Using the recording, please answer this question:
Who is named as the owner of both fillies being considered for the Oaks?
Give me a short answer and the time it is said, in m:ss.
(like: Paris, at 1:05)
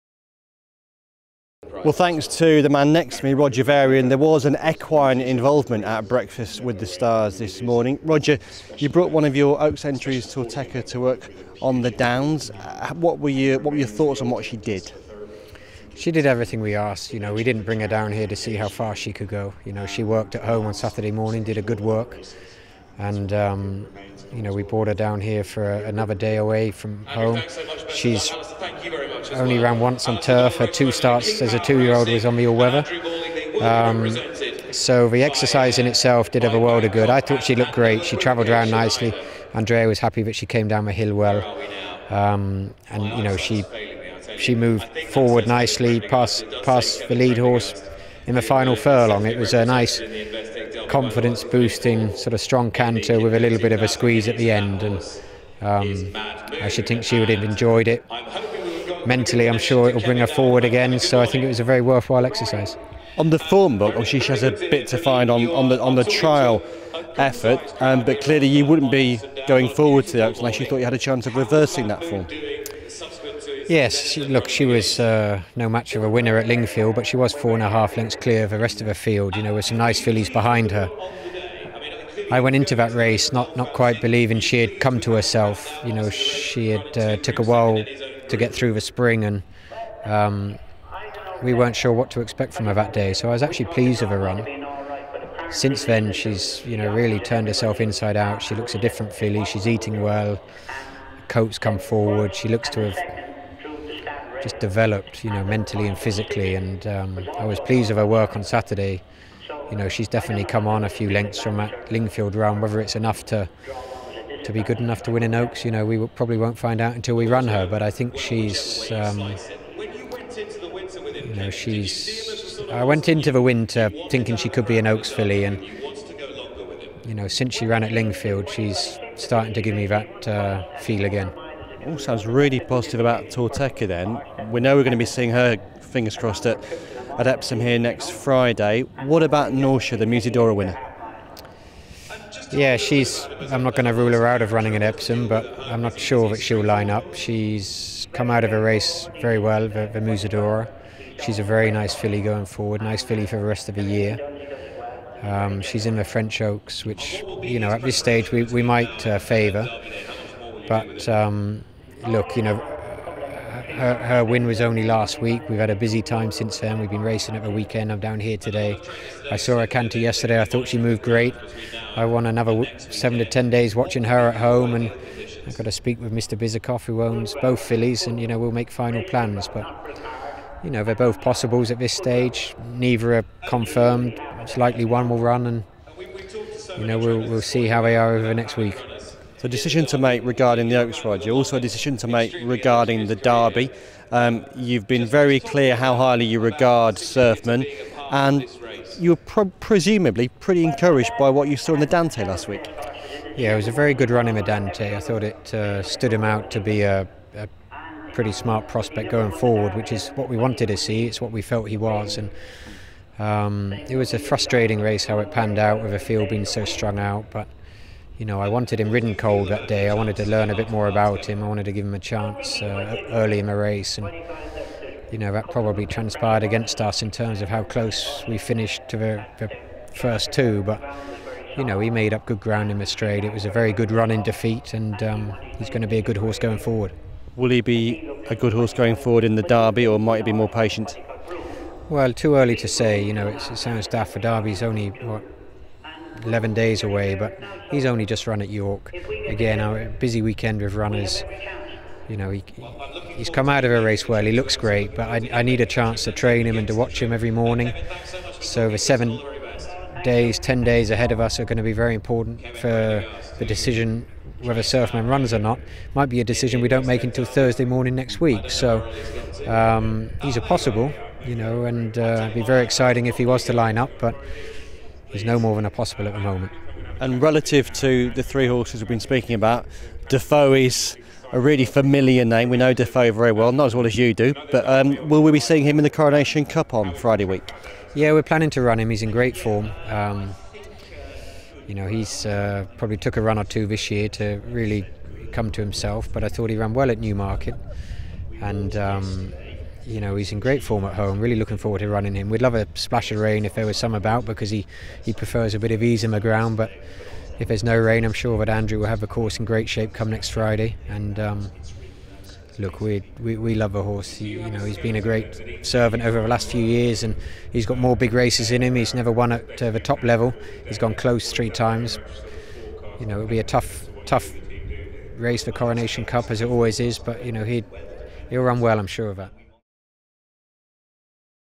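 Mr. Bizakov, at 2:56.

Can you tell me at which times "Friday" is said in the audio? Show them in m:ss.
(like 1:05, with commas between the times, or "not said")
2:18, 4:46, 5:10.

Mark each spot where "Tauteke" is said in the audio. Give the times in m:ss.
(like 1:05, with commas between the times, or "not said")
0:10, 2:13.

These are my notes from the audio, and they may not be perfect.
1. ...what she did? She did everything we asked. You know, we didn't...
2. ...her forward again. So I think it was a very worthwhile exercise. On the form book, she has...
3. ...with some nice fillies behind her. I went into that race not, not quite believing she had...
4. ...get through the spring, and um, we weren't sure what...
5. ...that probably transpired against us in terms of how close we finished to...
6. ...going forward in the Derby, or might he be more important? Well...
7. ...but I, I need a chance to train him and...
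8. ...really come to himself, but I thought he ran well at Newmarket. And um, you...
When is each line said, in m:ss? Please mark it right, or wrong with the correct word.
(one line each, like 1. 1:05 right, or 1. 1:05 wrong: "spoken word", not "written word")
1. 0:14 right
2. 1:00 right
3. 1:19 right
4. 1:28 right
5. 3:45 right
6. 3:58 wrong: "patient", not "important"
7. 4:14 right
8. 4:54 right.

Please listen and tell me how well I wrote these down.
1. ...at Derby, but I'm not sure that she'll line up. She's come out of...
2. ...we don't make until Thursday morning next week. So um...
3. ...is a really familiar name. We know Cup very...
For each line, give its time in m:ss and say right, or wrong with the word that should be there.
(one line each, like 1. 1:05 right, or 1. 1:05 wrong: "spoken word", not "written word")
1. 2:24 wrong: "Epsom", not "Derby"
2. 4:26 right
3. 4:40 wrong: "Defoe", not "Cup".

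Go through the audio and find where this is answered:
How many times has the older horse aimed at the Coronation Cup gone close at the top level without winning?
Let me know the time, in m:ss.
5:21.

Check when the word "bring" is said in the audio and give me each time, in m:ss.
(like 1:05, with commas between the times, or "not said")
0:17, 1:00.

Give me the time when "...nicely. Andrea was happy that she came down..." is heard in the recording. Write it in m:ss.
0:38.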